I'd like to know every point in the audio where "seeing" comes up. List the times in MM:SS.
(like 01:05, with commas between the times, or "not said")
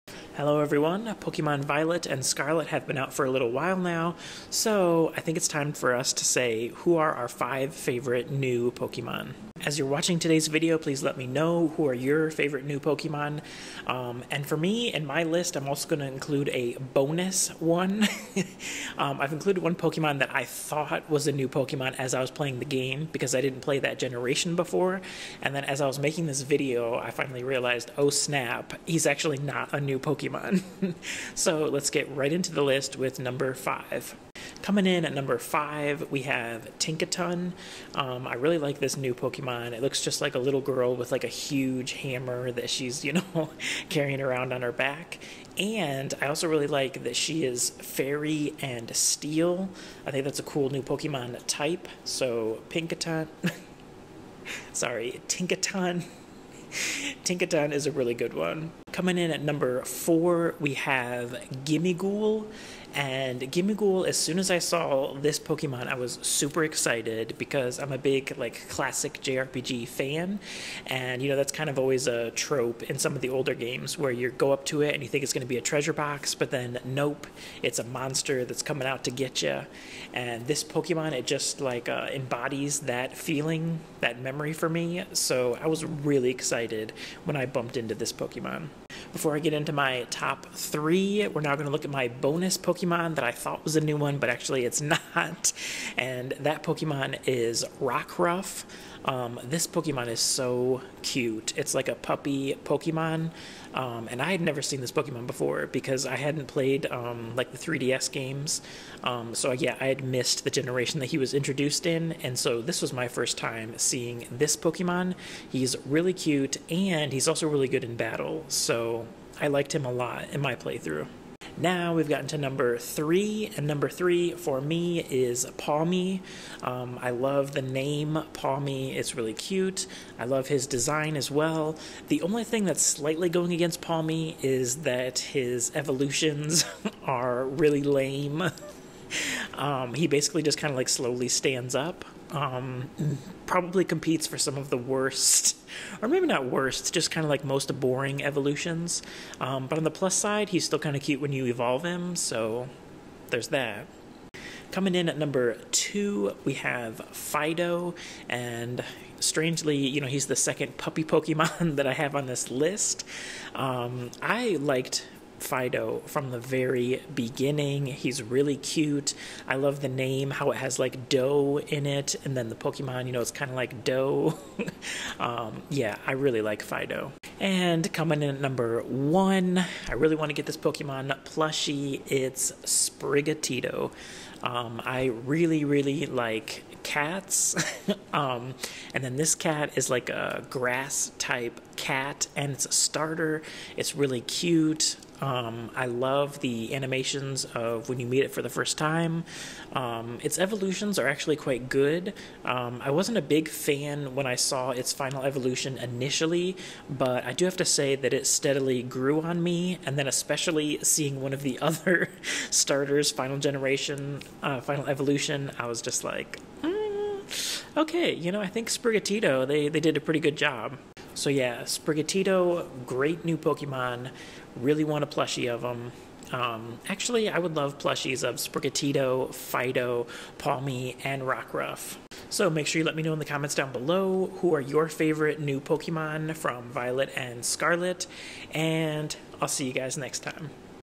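01:53, 03:30.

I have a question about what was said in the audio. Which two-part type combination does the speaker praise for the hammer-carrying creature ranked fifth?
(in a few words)
Fairy and steel.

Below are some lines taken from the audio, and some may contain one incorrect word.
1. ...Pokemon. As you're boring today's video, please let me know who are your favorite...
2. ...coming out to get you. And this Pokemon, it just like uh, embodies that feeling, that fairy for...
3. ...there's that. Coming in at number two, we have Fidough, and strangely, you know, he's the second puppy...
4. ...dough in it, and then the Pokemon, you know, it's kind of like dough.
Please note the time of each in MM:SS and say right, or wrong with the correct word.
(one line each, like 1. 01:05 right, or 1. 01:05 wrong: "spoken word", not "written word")
1. 00:08 wrong: "watching", not "boring"
2. 01:18 wrong: "memory", not "fairy"
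3. 02:33 right
4. 02:51 right.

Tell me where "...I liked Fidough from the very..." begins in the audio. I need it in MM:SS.
02:44.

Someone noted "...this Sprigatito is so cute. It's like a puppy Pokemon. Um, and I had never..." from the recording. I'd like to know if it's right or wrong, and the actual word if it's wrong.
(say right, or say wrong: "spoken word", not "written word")
wrong: "Pokemon", not "Sprigatito".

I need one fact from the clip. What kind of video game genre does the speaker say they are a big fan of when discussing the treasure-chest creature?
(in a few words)
Classic JRPG.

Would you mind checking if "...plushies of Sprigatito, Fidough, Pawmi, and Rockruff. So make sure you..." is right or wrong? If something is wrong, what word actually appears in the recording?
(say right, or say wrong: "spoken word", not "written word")
right.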